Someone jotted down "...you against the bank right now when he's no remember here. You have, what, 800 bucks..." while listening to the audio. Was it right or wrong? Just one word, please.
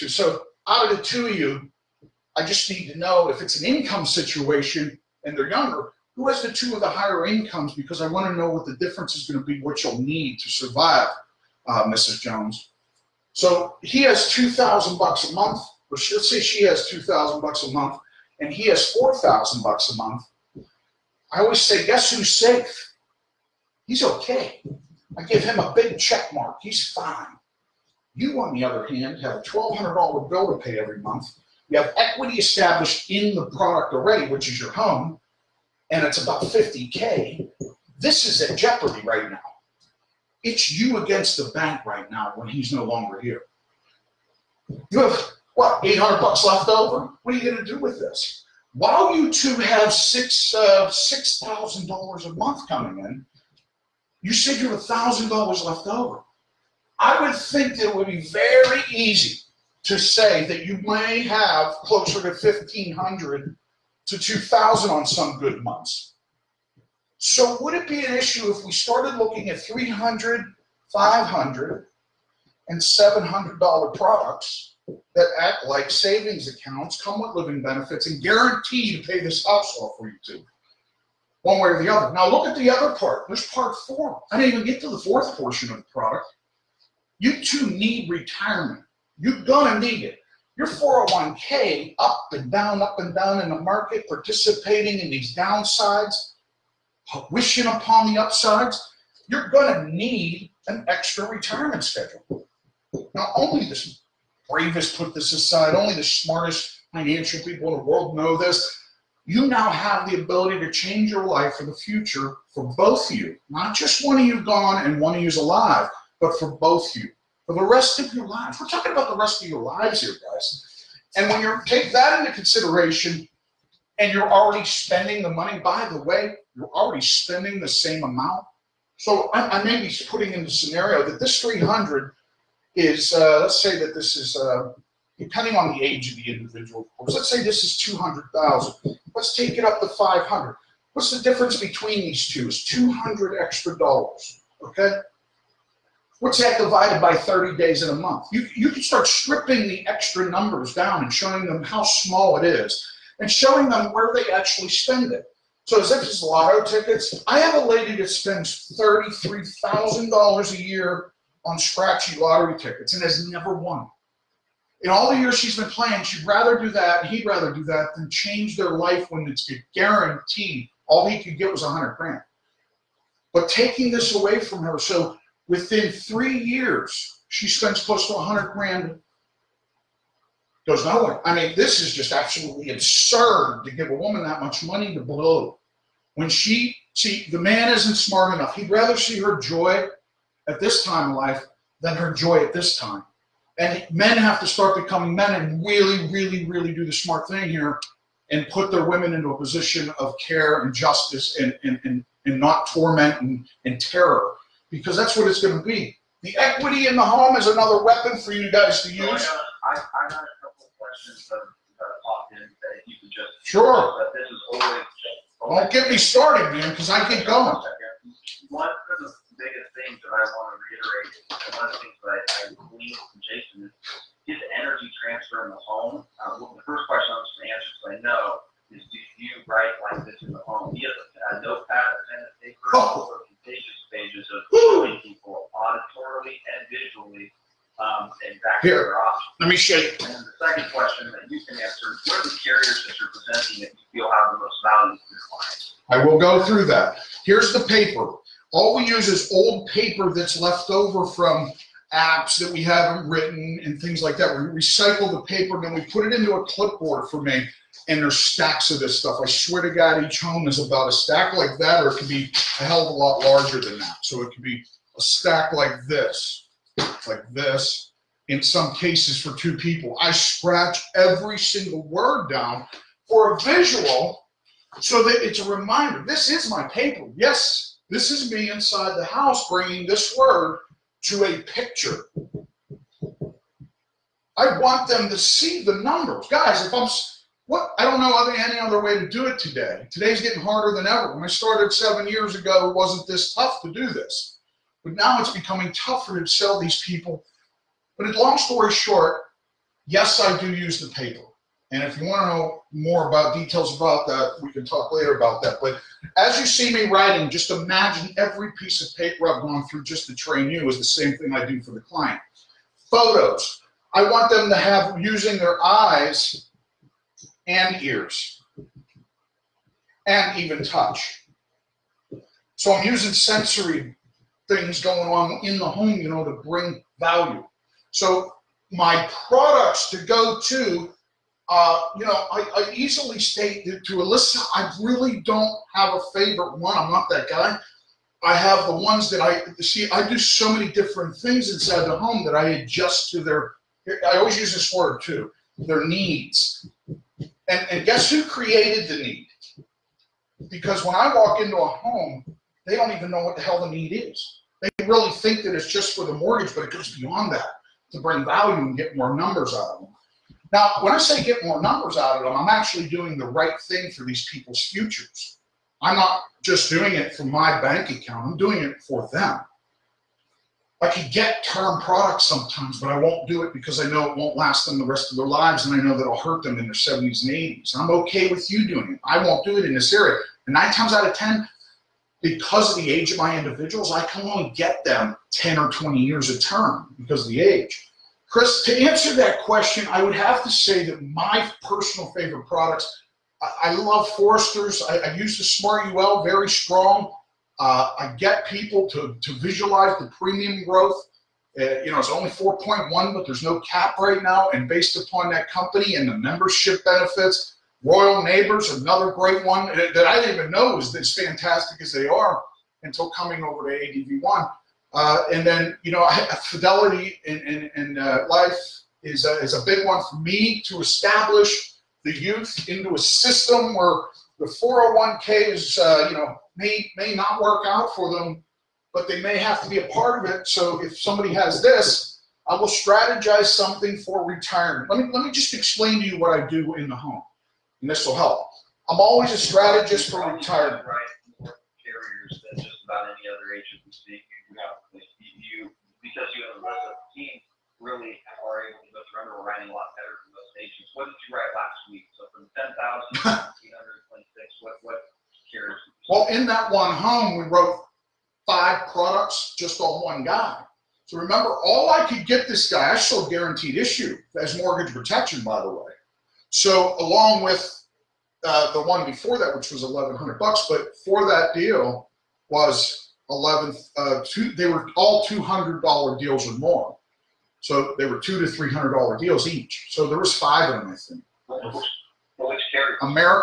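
wrong.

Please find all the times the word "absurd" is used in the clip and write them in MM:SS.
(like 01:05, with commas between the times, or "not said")
03:02.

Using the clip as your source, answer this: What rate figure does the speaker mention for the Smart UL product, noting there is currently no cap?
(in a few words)
4.1.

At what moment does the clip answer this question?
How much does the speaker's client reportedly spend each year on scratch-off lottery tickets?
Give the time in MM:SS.
02:38.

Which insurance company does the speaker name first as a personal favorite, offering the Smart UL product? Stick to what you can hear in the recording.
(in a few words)
Foresters.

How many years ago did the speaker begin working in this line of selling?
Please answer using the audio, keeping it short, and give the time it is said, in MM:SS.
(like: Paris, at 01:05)
7 years, at 04:51.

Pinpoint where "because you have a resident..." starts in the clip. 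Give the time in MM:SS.
07:26.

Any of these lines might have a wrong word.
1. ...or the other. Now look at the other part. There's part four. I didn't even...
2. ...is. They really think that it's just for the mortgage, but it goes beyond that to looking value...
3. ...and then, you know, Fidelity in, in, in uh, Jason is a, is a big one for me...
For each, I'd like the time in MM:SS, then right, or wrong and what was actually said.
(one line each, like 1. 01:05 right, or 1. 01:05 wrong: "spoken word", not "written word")
1. 01:21 right
2. 05:53 wrong: "bring", not "looking"
3. 06:55 wrong: "Life", not "Jason".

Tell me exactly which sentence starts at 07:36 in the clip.
Well, in that one home, we wrote five products just on one guy.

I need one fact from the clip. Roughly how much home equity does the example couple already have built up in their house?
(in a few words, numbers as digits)
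50K.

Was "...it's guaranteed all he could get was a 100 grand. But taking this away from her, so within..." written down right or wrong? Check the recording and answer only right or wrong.
right.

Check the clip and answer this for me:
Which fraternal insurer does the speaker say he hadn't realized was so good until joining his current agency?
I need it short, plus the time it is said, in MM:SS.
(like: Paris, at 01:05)
Royal Neighbors, at 06:47.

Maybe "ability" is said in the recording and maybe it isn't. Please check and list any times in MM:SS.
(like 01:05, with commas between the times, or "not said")
01:50.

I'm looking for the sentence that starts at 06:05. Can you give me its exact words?
I'm not just doing it for my bank account, I'm doing it for them.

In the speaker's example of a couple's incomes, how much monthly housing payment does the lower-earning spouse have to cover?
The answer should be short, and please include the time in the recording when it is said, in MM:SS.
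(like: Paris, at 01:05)
$1,200, at 00:29.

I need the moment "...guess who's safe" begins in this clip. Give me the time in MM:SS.
00:21.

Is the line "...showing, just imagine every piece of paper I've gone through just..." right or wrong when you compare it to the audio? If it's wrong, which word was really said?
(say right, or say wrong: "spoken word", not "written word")
wrong: "writing", not "showing".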